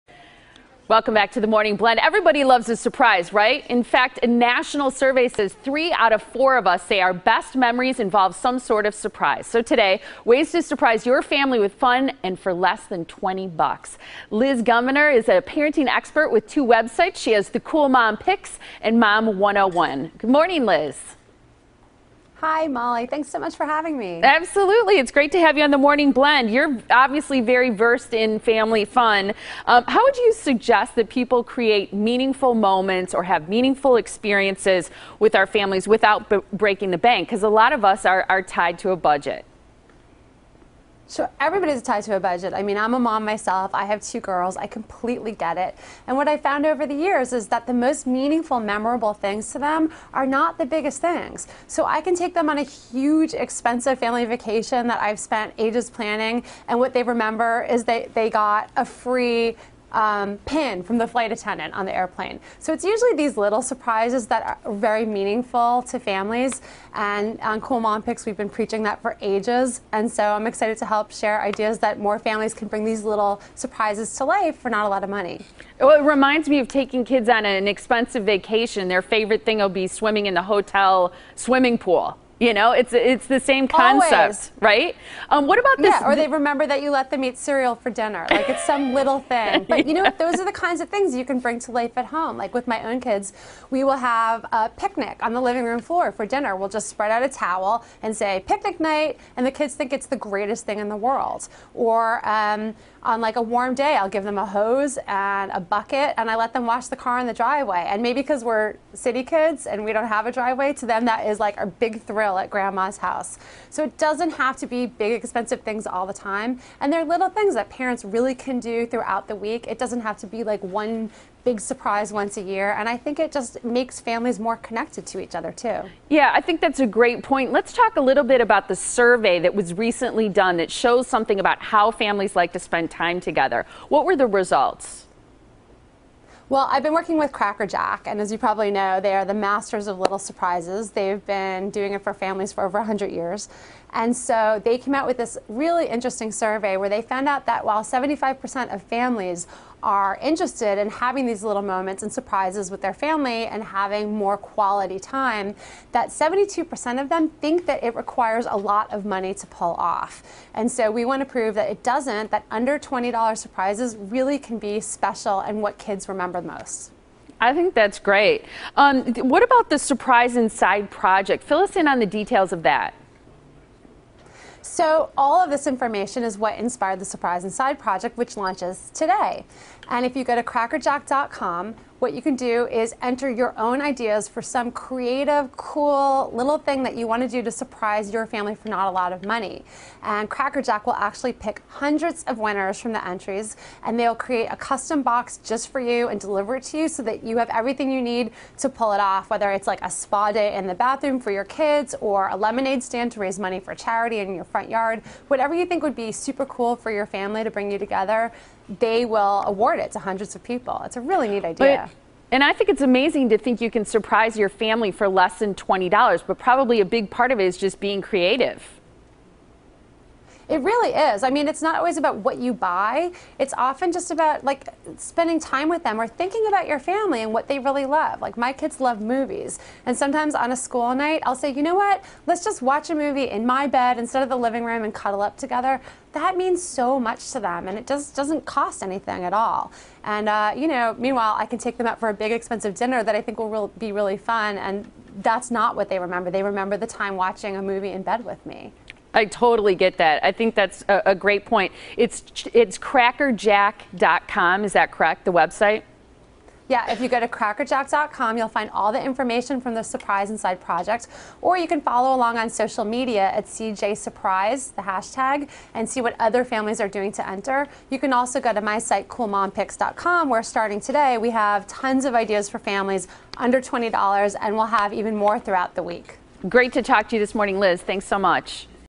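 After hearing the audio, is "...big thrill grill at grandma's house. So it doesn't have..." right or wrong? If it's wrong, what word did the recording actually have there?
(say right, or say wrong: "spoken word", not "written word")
right.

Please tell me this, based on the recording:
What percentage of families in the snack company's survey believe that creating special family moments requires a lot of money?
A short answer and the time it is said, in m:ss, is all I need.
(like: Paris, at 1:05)
72%, at 2:36.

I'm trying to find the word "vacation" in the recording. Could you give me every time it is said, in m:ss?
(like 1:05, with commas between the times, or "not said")
0:54, 1:18.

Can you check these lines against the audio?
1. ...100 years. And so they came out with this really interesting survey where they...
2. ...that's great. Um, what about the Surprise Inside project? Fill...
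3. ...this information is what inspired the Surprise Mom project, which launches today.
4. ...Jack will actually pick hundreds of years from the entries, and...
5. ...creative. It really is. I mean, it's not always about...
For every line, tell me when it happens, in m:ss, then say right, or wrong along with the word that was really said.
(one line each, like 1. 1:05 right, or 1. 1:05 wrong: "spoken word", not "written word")
1. 2:22 right
2. 2:47 right
3. 2:55 wrong: "Inside", not "Mom"
4. 3:10 wrong: "winners", not "years"
5. 3:38 right.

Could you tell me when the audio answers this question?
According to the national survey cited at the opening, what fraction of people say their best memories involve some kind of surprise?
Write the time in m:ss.
0:05.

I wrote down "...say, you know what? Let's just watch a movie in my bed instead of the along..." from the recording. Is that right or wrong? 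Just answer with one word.
wrong.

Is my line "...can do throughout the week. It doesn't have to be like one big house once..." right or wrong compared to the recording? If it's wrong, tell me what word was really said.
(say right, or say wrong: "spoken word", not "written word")
wrong: "surprise", not "house".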